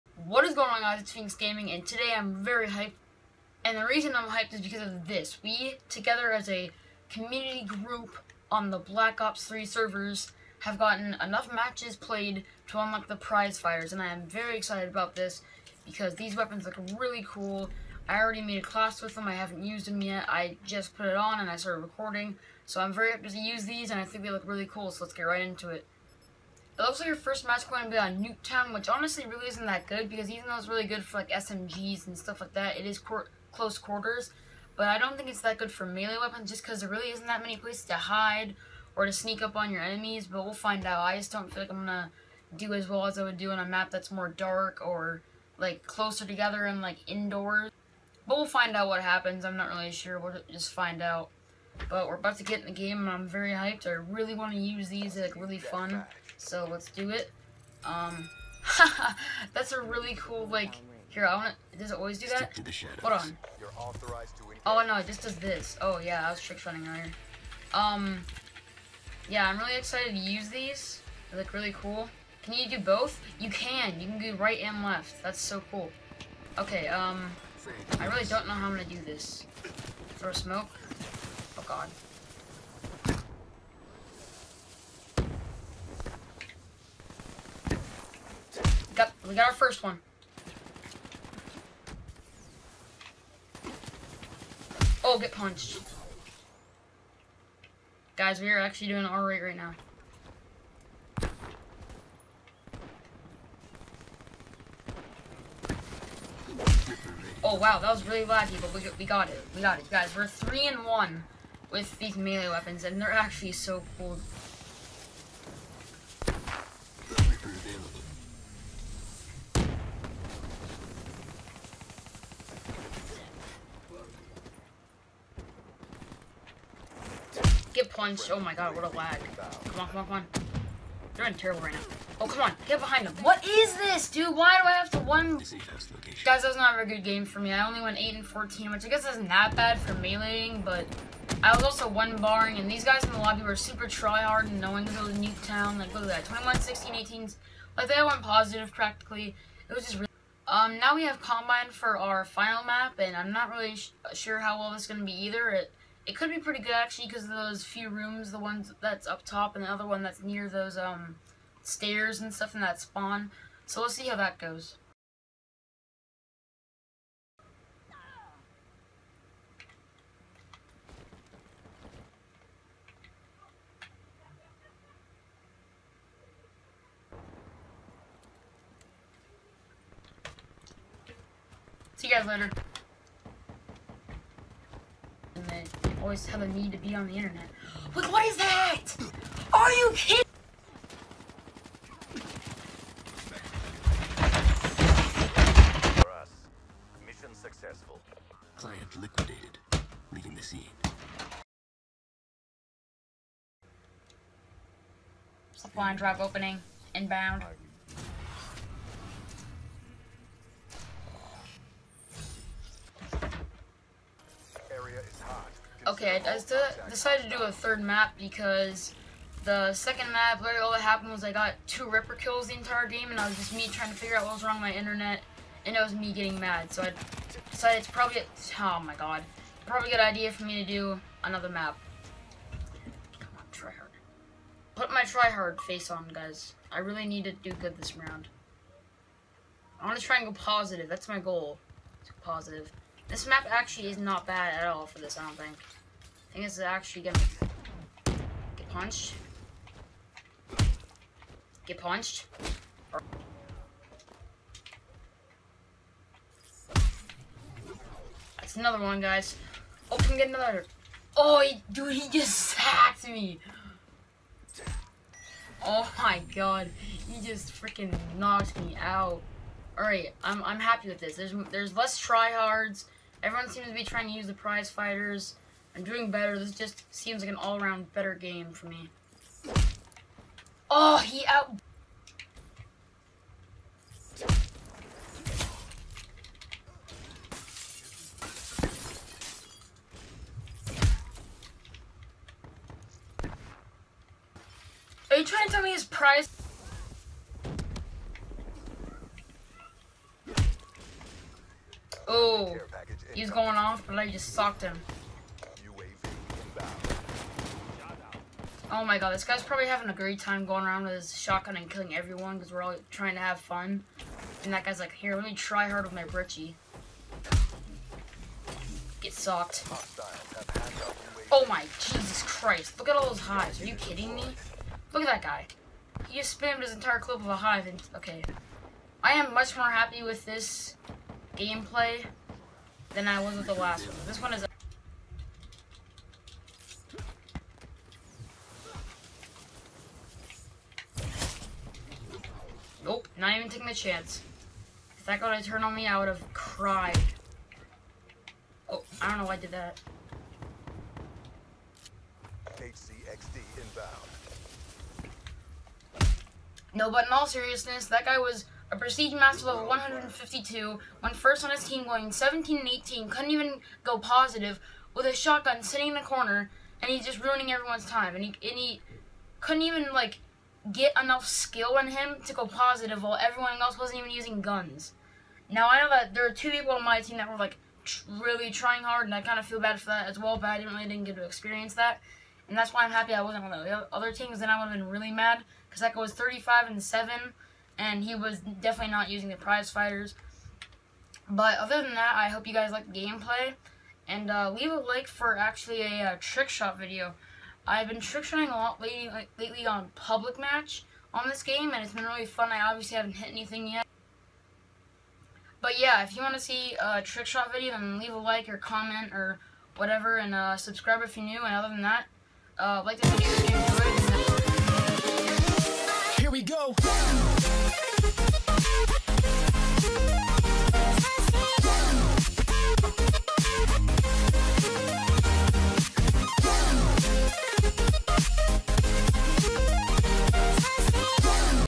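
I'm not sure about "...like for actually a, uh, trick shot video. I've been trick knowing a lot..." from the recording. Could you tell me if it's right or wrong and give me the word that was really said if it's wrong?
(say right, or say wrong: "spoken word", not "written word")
wrong: "shotting", not "knowing".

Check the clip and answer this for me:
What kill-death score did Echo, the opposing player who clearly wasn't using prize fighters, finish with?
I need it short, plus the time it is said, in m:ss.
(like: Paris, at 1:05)
35 and 7, at 6:26.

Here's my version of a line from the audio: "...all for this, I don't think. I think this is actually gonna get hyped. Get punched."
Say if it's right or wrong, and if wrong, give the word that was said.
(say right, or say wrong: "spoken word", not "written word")
wrong: "punched", not "hyped".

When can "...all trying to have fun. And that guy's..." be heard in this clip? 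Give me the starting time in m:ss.
5:12.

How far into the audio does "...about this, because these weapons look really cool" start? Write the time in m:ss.
0:14.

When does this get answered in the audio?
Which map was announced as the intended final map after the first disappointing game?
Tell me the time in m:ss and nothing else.
2:31.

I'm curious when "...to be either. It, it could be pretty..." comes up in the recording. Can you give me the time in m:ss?
2:34.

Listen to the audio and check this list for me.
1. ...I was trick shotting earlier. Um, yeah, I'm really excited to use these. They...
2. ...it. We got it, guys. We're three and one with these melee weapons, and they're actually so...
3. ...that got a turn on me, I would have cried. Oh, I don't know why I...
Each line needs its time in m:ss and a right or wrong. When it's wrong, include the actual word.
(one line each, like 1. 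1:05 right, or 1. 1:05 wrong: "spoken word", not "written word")
1. 1:06 right
2. 1:49 right
3. 5:45 right.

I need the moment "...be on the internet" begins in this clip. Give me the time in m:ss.
3:06.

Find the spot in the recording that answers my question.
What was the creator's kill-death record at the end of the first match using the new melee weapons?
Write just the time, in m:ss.
2:17.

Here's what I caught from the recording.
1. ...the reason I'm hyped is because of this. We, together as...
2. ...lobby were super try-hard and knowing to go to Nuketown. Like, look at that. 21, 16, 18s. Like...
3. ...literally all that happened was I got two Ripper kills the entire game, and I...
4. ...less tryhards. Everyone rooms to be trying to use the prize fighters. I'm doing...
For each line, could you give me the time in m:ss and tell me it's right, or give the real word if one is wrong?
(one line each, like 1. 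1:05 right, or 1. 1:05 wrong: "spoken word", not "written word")
1. 0:03 right
2. 2:23 right
3. 3:40 right
4. 4:31 wrong: "seems", not "rooms".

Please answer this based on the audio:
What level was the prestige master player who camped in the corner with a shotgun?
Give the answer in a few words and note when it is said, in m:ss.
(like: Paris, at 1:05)
152, at 5:59.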